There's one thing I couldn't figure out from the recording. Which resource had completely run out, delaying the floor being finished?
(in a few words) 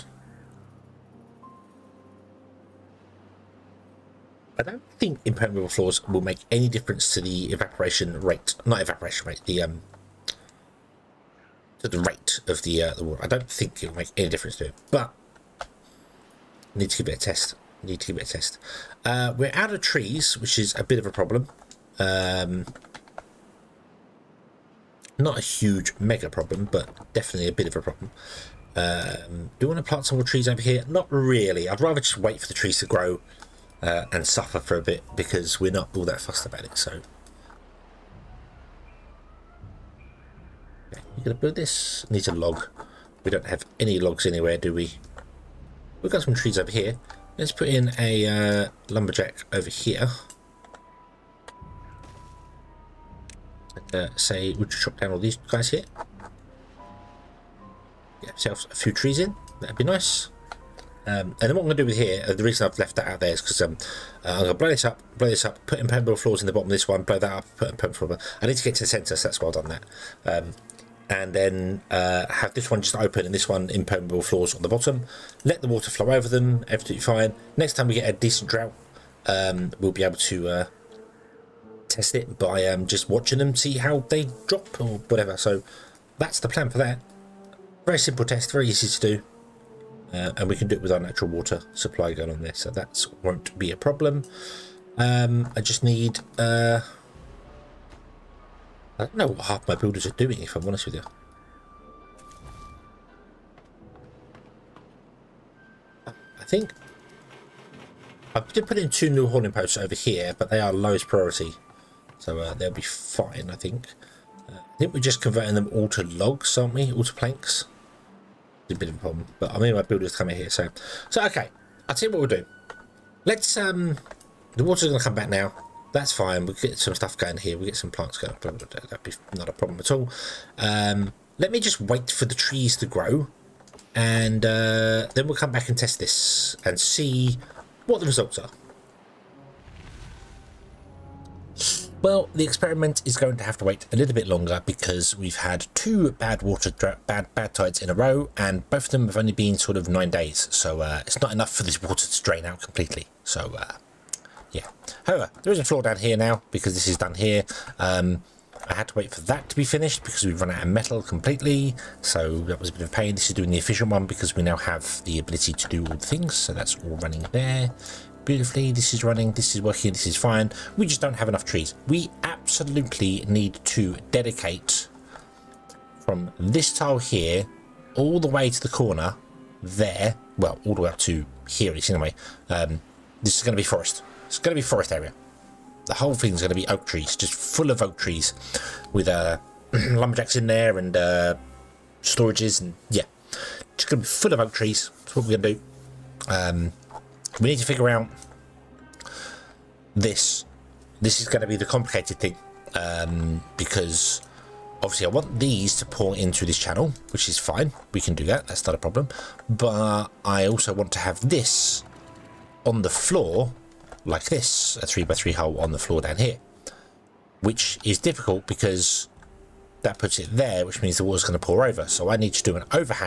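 Metal.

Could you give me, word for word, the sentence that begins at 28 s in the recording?
Um, do you want to plant some more trees over here?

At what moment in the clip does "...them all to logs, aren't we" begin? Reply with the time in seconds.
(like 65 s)
115 s.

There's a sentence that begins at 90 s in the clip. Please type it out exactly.
Uh, and we can do it with our natural water supply going on there.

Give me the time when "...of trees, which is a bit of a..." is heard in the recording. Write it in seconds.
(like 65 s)
19 s.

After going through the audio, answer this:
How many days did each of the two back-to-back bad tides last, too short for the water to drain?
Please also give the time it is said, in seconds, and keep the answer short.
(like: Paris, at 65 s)
9, at 149 s.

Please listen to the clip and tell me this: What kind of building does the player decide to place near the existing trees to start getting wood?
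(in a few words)
Lumberjack.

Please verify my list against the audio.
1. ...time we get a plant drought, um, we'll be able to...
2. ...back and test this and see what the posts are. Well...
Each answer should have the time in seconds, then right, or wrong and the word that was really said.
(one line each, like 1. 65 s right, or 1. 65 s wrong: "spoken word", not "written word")
1. 77 s wrong: "decent", not "plant"
2. 135 s wrong: "results", not "posts".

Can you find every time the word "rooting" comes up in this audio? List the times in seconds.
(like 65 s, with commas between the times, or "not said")
not said.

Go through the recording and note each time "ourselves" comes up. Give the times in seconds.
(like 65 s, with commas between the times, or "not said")
58 s.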